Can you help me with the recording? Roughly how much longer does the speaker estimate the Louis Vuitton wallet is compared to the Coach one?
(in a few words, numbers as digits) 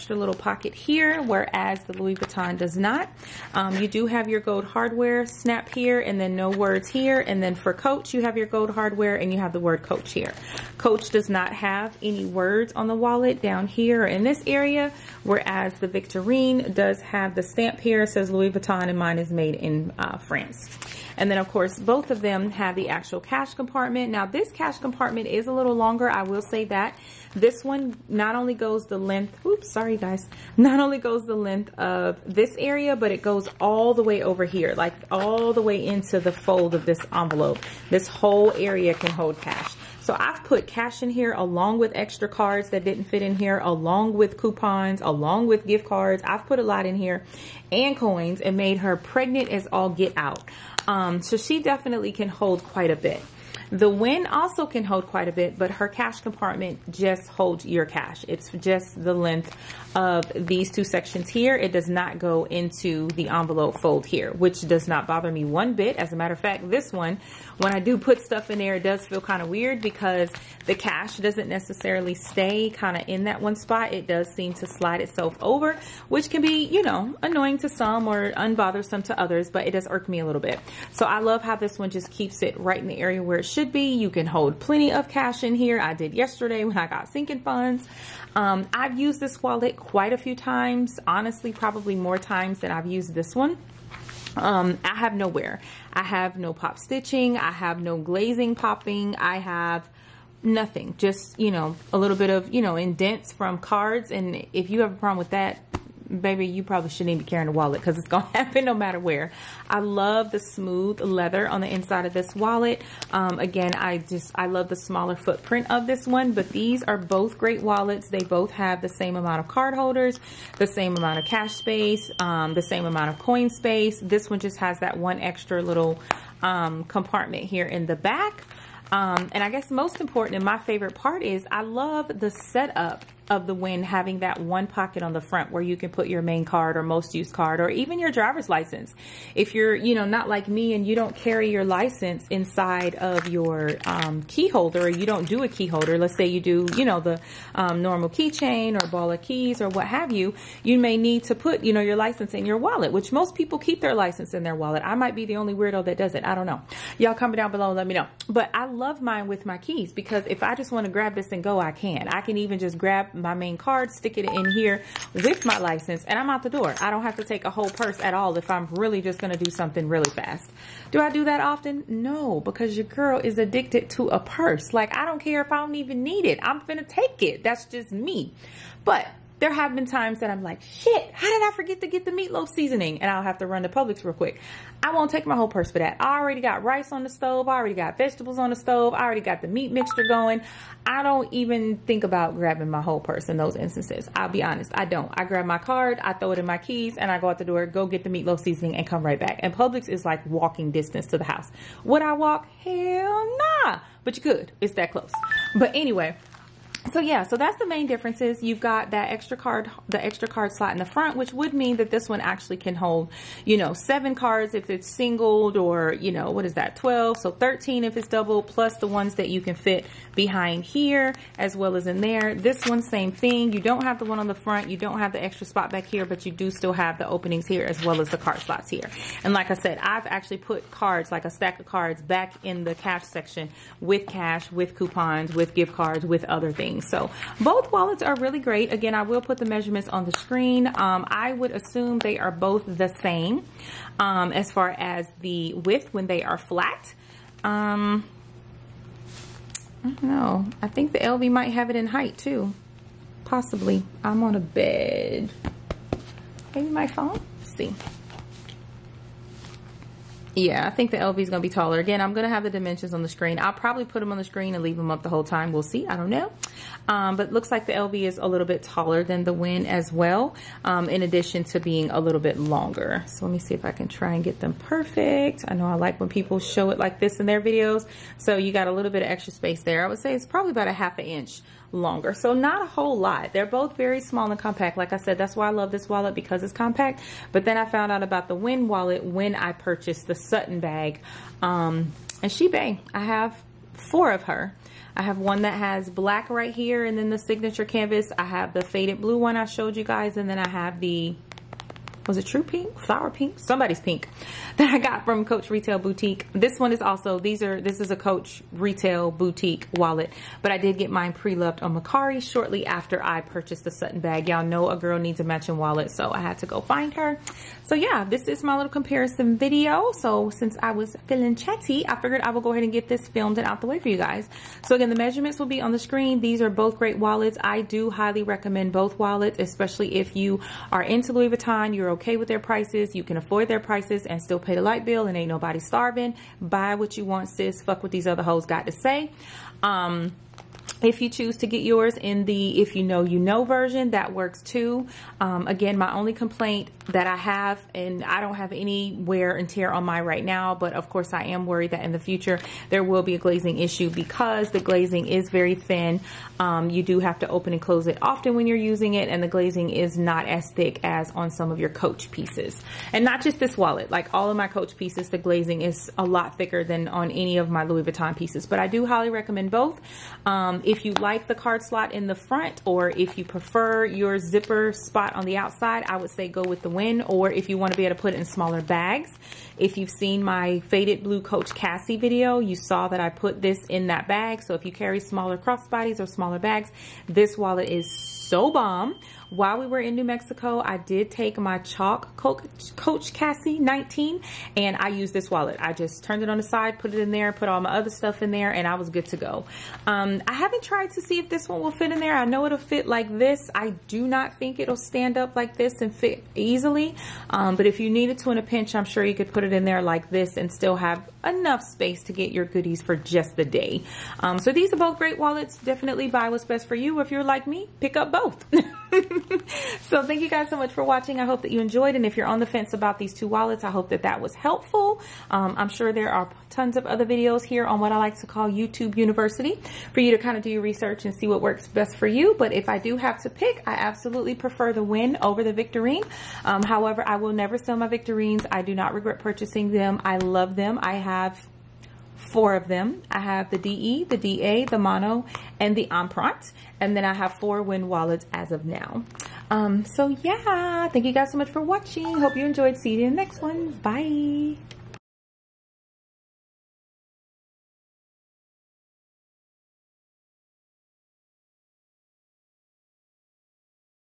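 half an inch.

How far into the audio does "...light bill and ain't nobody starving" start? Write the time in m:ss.
5:34.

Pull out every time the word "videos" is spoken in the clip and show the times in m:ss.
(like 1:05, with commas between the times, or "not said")
4:37, 5:19, 6:21, 7:07.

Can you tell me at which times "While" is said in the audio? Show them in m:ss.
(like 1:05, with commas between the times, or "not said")
6:29.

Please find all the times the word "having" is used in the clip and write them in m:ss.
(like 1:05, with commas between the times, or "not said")
2:13.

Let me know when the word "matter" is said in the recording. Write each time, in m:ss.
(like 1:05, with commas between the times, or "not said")
1:06, 1:48.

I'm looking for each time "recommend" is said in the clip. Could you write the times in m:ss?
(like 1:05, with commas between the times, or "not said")
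5:28, 6:09.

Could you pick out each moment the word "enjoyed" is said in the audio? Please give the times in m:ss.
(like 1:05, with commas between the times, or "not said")
7:01, 7:32.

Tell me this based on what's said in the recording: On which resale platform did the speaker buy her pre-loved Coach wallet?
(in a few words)
Mercari.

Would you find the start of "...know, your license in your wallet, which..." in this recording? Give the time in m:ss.
2:31.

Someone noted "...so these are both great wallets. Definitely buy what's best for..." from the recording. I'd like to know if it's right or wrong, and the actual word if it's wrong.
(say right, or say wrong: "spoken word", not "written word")
right.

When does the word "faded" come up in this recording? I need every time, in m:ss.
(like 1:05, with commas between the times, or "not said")
4:58, 6:20.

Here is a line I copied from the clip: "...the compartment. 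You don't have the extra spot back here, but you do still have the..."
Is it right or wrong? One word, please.
wrong.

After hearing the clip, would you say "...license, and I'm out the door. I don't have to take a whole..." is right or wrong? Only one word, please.
right.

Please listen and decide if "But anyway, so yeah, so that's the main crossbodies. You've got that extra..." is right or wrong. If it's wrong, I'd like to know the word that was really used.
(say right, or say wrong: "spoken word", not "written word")
wrong: "differences", not "crossbodies".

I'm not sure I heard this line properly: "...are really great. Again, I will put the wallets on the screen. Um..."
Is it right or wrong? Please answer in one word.
wrong.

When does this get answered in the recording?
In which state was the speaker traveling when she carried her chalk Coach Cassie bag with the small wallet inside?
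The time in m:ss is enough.
6:29.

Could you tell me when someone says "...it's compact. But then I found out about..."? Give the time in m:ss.
4:46.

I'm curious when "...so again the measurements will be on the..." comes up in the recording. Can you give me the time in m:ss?
5:24.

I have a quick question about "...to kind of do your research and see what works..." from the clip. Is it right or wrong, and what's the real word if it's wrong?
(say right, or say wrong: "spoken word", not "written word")
right.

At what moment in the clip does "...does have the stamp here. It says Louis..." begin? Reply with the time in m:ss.
0:16.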